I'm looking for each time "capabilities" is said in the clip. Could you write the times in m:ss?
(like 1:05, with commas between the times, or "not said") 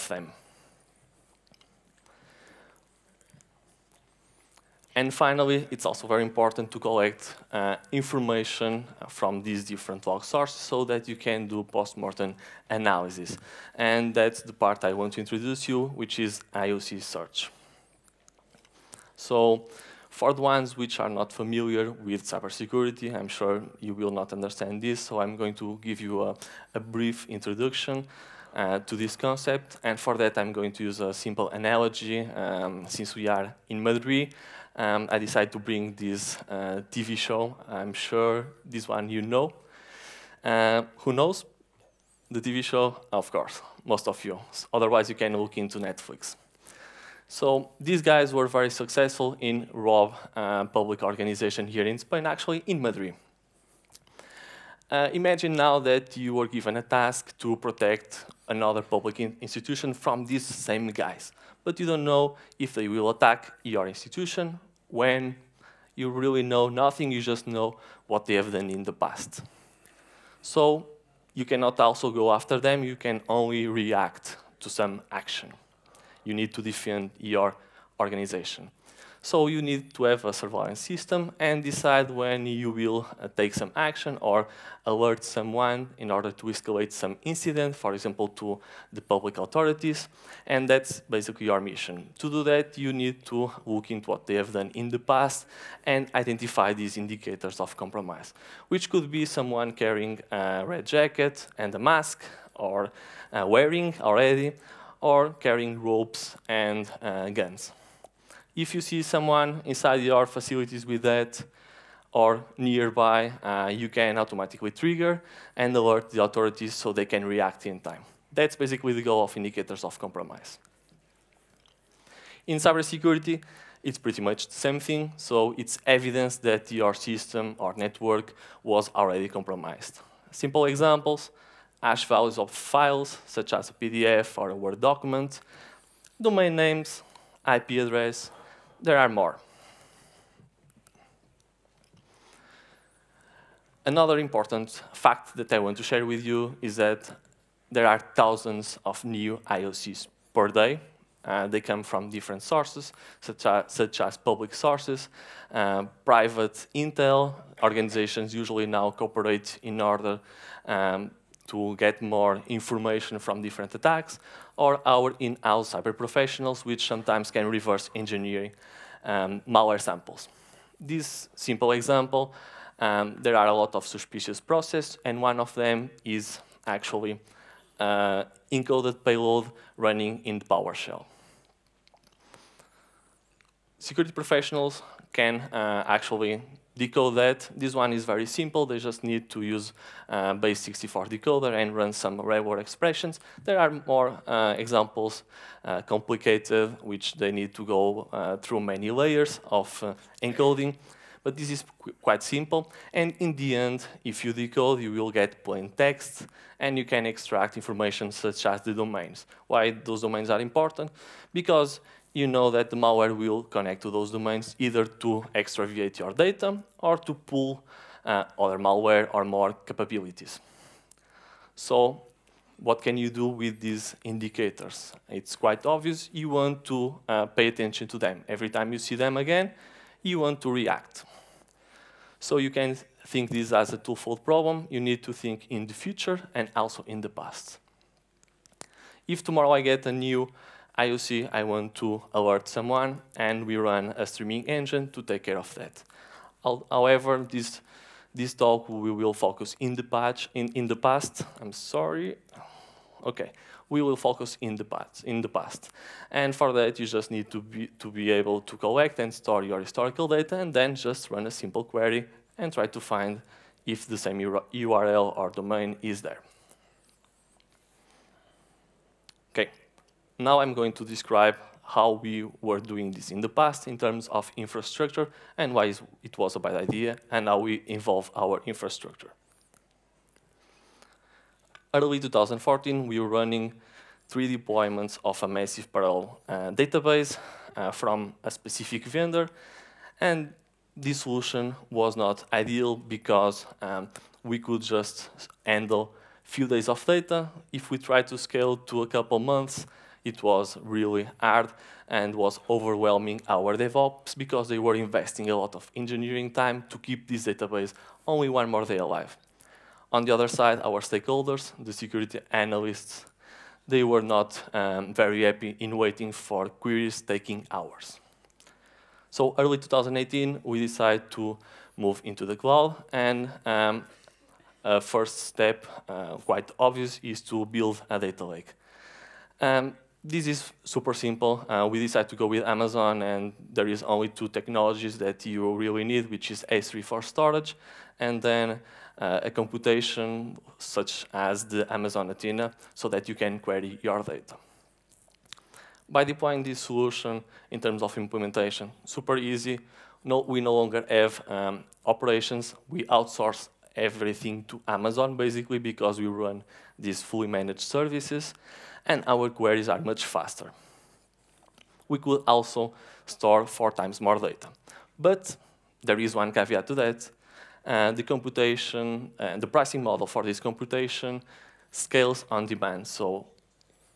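3:39.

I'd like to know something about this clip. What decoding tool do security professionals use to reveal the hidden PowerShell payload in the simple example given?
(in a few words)
base64 decoder.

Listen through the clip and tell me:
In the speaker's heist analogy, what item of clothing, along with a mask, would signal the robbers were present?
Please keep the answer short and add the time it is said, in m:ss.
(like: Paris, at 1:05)
red jacket, at 1:40.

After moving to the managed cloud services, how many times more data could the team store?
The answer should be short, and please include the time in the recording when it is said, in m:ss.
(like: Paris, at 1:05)
4 times, at 6:03.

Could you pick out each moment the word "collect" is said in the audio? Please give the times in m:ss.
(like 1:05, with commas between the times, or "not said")
0:06, 4:18.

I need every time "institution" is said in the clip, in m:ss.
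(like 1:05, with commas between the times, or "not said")
0:59, 1:03.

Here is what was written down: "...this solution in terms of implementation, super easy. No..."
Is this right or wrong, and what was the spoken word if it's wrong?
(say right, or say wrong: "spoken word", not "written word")
right.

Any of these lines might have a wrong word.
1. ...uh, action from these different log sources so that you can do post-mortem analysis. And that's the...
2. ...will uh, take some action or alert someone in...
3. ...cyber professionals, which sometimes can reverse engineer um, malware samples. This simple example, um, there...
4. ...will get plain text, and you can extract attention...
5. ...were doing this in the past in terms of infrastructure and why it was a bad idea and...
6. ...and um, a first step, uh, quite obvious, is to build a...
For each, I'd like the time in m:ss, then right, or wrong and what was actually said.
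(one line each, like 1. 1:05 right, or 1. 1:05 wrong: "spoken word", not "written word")
1. 0:07 wrong: "information", not "action"
2. 1:22 right
3. 2:45 right
4. 3:24 wrong: "information", not "attention"
5. 4:32 right
6. 5:22 right.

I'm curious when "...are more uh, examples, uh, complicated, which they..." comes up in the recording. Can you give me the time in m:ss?
3:13.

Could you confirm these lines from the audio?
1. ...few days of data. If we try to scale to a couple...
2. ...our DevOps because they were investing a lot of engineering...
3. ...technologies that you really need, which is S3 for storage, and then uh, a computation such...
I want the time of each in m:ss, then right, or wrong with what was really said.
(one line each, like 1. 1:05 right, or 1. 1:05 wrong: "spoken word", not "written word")
1. 4:56 right
2. 5:03 right
3. 5:34 right.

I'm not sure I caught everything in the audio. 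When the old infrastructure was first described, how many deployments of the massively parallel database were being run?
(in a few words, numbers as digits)
3.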